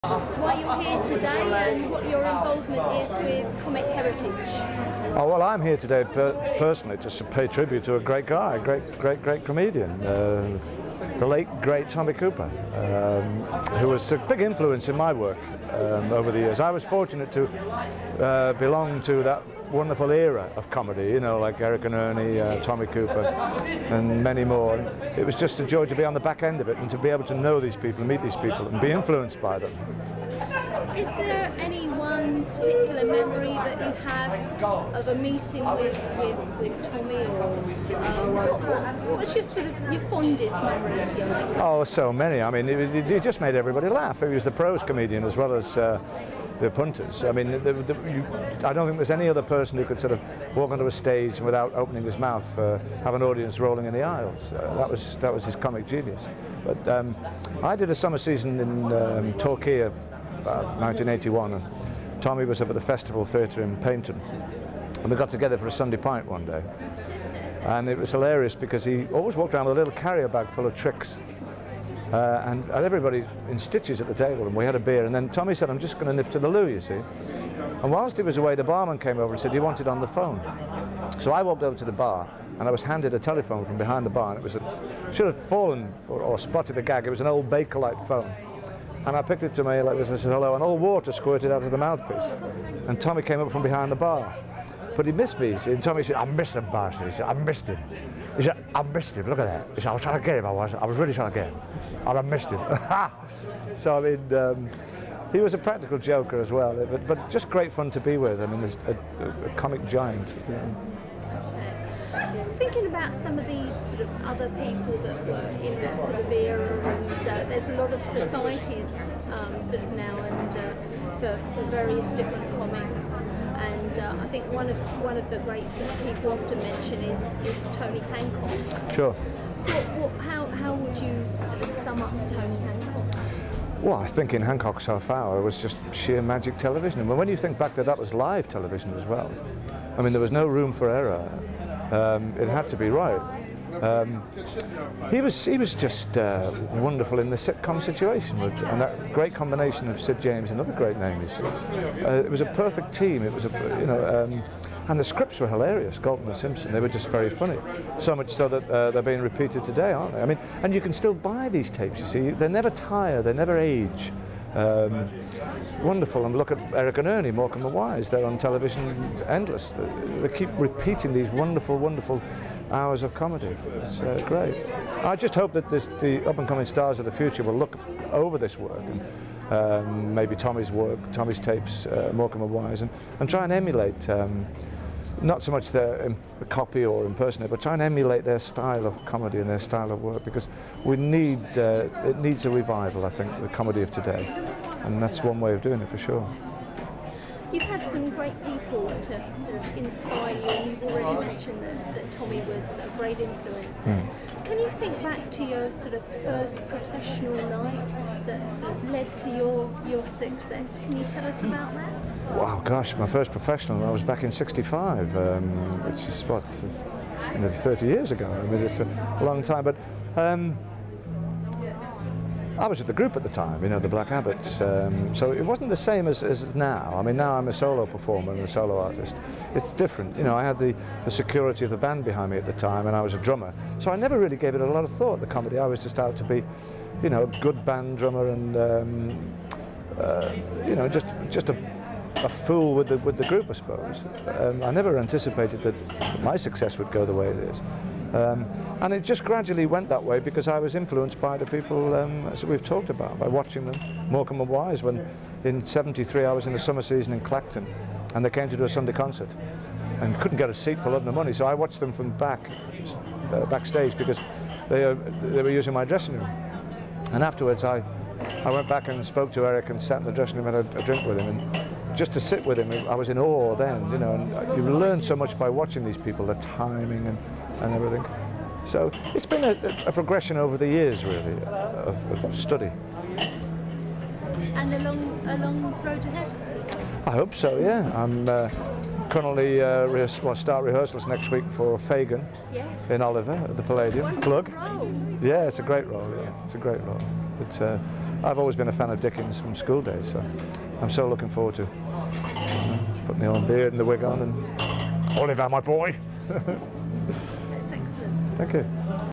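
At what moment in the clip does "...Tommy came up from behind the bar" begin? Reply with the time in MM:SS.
01:33.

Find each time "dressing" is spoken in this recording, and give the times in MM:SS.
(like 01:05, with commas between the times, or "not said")
04:25, 04:30.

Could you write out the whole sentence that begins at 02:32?
Uh, it was a perfect team.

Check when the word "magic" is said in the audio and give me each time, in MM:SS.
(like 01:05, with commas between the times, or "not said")
02:16.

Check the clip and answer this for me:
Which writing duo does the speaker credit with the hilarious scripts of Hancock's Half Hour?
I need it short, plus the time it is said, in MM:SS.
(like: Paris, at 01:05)
Galton and Simpson, at 02:35.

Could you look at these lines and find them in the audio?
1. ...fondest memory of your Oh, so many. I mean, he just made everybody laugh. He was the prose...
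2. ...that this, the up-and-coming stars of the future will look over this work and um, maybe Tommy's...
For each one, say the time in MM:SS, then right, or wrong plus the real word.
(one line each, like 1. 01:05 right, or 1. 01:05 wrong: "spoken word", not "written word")
1. 00:40 right
2. 02:55 right.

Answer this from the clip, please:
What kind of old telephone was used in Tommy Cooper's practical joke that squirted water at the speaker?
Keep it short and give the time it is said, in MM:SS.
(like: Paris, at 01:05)
Bakelite, at 01:27.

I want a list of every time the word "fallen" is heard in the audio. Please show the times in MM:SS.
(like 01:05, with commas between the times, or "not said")
01:25.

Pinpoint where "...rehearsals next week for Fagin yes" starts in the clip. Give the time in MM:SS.
04:50.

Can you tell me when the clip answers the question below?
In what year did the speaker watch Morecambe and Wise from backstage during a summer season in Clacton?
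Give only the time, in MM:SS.
04:15.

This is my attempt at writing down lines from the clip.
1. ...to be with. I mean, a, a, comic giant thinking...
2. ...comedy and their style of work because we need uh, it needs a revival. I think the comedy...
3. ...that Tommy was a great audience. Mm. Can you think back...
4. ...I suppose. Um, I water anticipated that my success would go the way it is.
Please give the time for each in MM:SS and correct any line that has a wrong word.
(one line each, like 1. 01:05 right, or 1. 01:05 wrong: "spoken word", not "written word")
1. 01:47 right
2. 03:09 right
3. 03:21 wrong: "influence", not "audience"
4. 04:03 wrong: "never", not "water".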